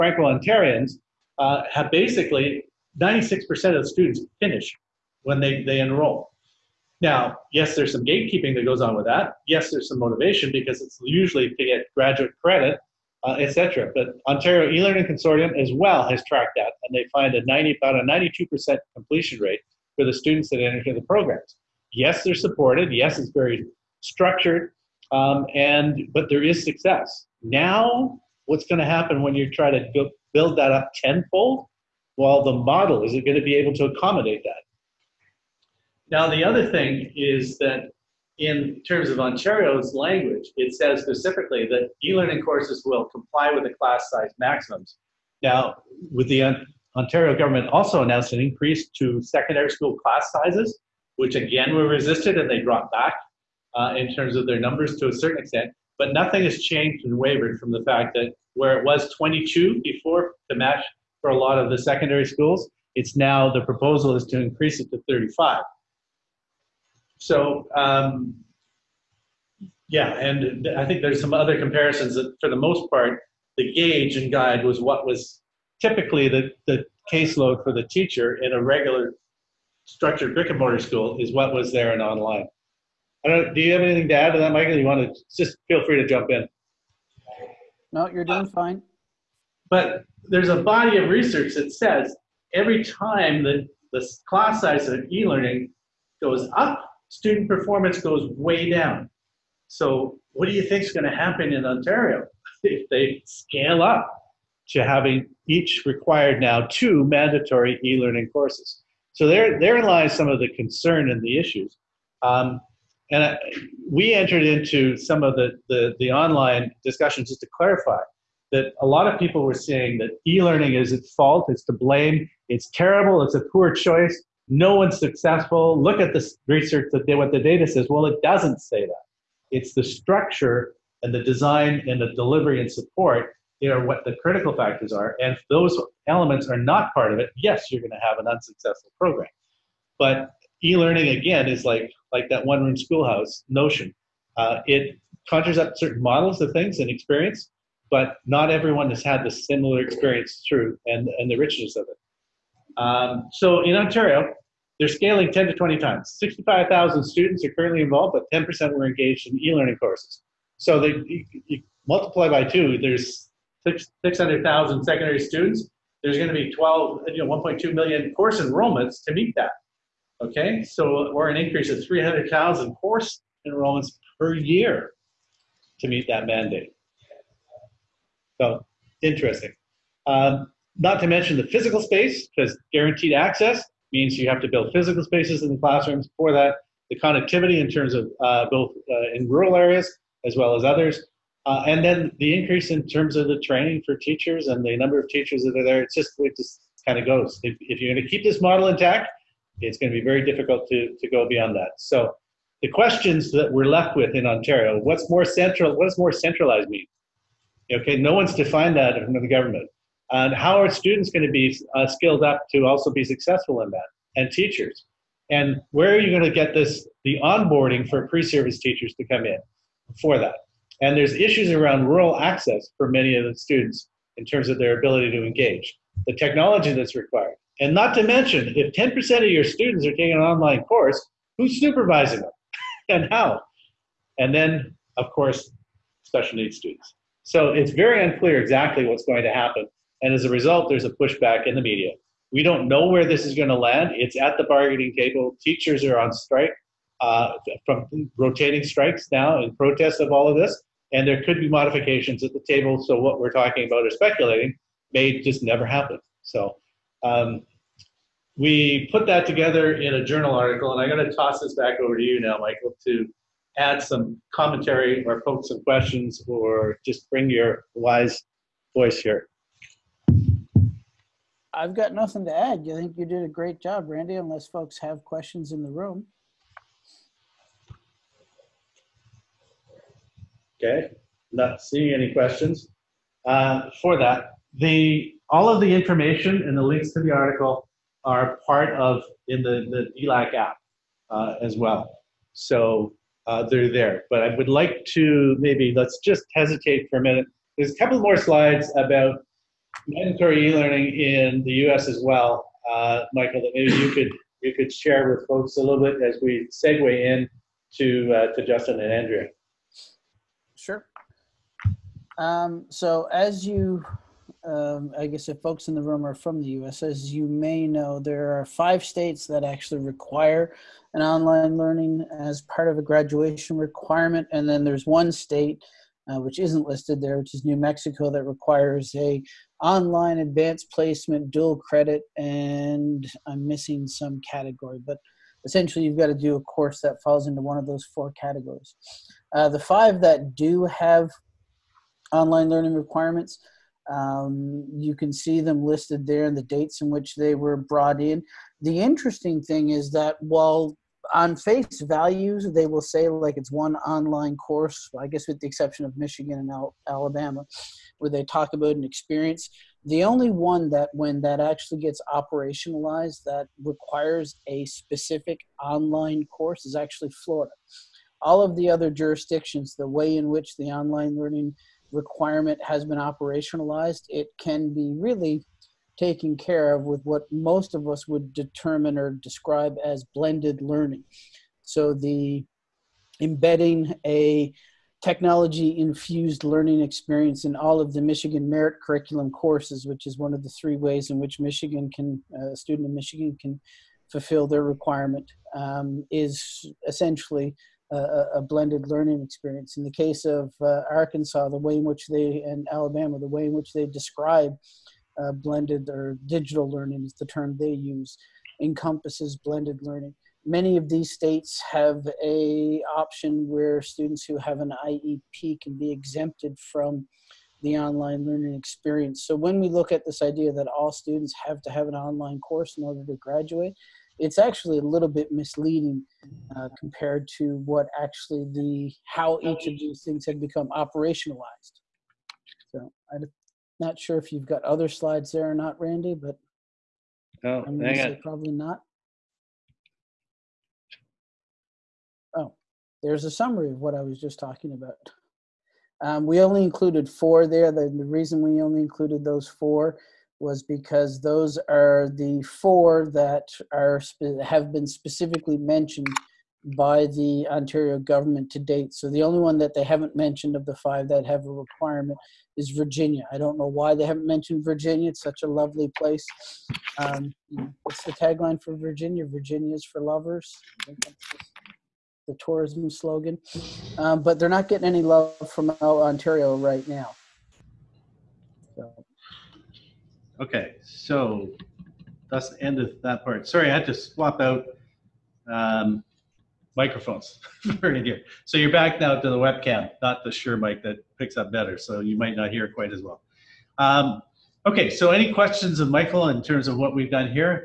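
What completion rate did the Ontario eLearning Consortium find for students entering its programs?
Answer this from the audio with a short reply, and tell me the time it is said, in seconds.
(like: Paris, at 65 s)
92%, at 18 s.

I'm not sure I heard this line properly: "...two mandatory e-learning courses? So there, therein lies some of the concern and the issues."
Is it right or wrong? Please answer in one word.
right.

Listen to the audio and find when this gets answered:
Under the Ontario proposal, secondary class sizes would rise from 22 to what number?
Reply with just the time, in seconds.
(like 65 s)
65 s.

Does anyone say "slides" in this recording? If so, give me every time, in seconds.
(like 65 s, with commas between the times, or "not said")
298 s, 434 s.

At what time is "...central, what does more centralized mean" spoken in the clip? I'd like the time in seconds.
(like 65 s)
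205 s.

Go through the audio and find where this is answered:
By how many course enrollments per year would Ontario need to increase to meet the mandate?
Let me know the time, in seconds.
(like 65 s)
171 s.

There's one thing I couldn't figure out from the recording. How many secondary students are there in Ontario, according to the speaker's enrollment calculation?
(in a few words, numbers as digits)
600,000.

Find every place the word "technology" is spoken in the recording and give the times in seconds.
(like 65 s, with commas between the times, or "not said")
226 s, 385 s.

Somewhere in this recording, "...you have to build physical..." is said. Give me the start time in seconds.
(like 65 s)
184 s.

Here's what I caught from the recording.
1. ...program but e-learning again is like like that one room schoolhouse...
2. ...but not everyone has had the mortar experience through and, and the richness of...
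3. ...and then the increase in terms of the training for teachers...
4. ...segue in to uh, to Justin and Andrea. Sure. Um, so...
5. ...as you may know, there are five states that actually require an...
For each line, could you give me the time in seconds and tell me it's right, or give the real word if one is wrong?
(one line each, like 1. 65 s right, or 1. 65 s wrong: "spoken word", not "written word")
1. 138 s right
2. 147 s wrong: "similar", not "mortar"
3. 191 s right
4. 306 s right
5. 316 s right.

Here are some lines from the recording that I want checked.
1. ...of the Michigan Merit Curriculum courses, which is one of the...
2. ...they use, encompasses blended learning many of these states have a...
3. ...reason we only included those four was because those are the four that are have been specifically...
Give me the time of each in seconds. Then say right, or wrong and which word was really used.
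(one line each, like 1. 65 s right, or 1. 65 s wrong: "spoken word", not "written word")
1. 387 s right
2. 407 s right
3. 448 s right.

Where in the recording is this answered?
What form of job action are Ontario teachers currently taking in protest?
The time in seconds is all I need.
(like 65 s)
248 s.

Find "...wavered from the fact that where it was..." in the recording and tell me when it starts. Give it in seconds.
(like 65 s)
57 s.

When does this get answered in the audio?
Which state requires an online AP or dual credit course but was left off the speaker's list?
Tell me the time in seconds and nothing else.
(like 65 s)
327 s.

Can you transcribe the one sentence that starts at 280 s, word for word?
Okay, not seeing any questions uh, for that.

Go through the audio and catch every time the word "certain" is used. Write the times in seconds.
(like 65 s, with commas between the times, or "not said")
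55 s, 145 s.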